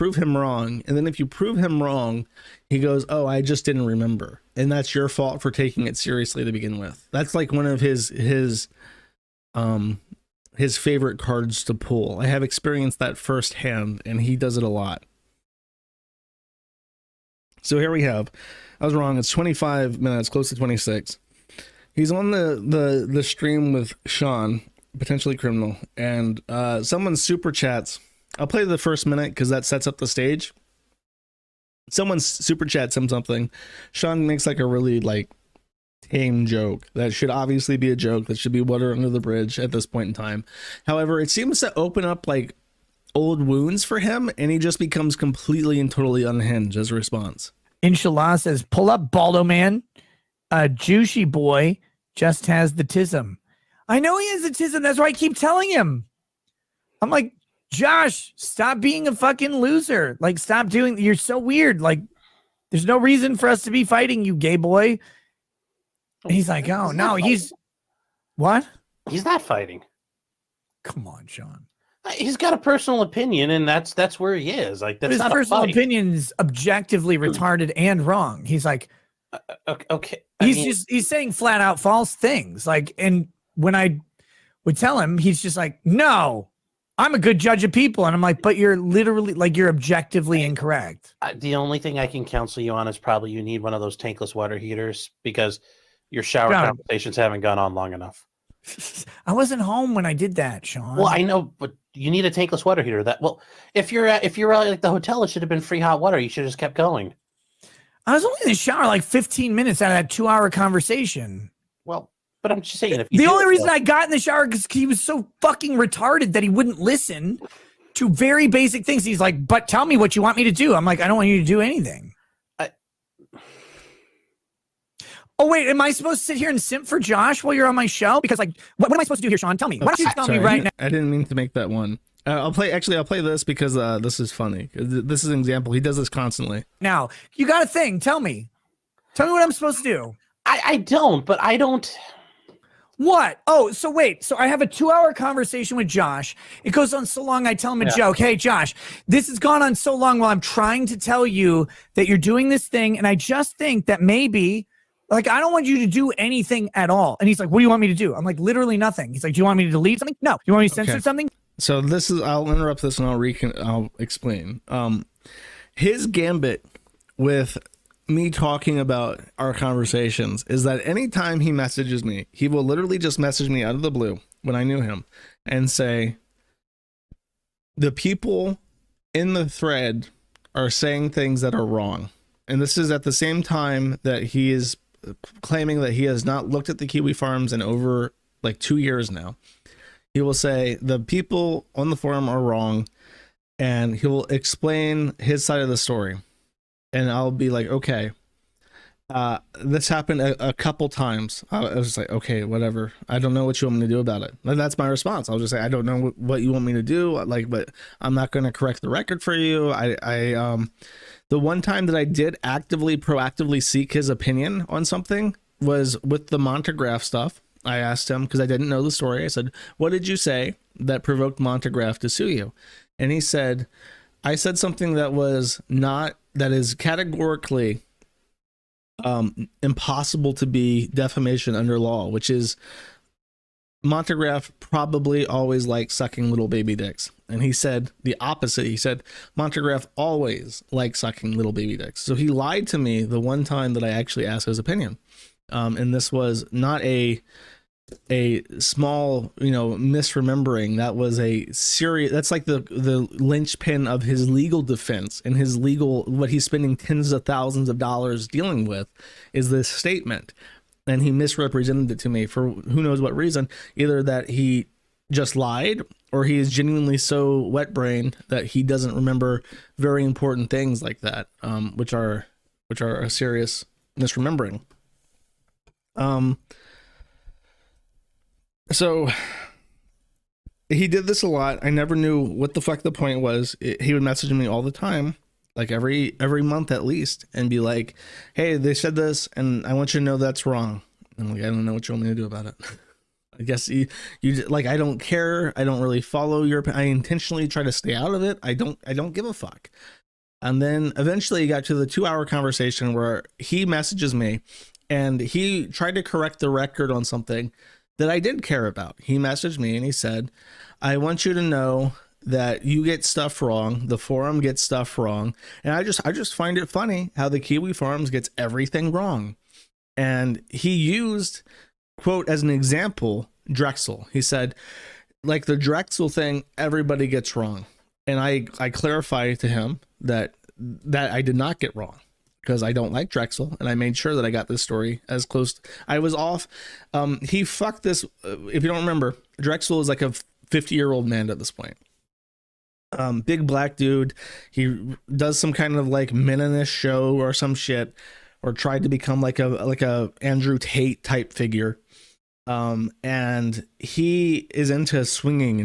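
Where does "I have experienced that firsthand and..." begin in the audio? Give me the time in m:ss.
0:12.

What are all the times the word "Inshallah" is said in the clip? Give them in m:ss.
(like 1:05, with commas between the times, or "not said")
0:47.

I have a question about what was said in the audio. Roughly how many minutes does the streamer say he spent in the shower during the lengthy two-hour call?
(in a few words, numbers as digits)
15.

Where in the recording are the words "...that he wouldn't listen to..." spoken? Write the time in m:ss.
1:56.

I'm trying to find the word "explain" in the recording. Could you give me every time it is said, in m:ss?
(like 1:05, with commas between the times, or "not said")
2:43, 3:14.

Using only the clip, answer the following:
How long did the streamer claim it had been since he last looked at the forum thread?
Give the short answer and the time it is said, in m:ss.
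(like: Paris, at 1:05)
2 years, at 3:08.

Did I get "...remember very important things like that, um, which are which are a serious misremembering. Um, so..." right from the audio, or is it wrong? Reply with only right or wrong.
right.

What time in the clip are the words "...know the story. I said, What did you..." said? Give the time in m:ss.
3:38.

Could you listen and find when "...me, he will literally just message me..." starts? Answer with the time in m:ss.
2:52.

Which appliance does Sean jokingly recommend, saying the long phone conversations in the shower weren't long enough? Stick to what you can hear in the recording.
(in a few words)
tankless water heater.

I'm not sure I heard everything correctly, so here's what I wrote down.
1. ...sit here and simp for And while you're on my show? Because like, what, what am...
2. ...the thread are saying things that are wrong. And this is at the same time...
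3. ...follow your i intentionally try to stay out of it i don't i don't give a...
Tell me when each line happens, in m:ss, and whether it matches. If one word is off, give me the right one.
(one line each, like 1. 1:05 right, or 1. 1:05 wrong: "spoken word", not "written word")
1. 2:06 wrong: "Josh", not "And"
2. 2:59 right
3. 4:56 right.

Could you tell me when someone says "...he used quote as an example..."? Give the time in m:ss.
5:20.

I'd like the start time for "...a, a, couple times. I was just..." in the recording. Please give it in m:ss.
3:20.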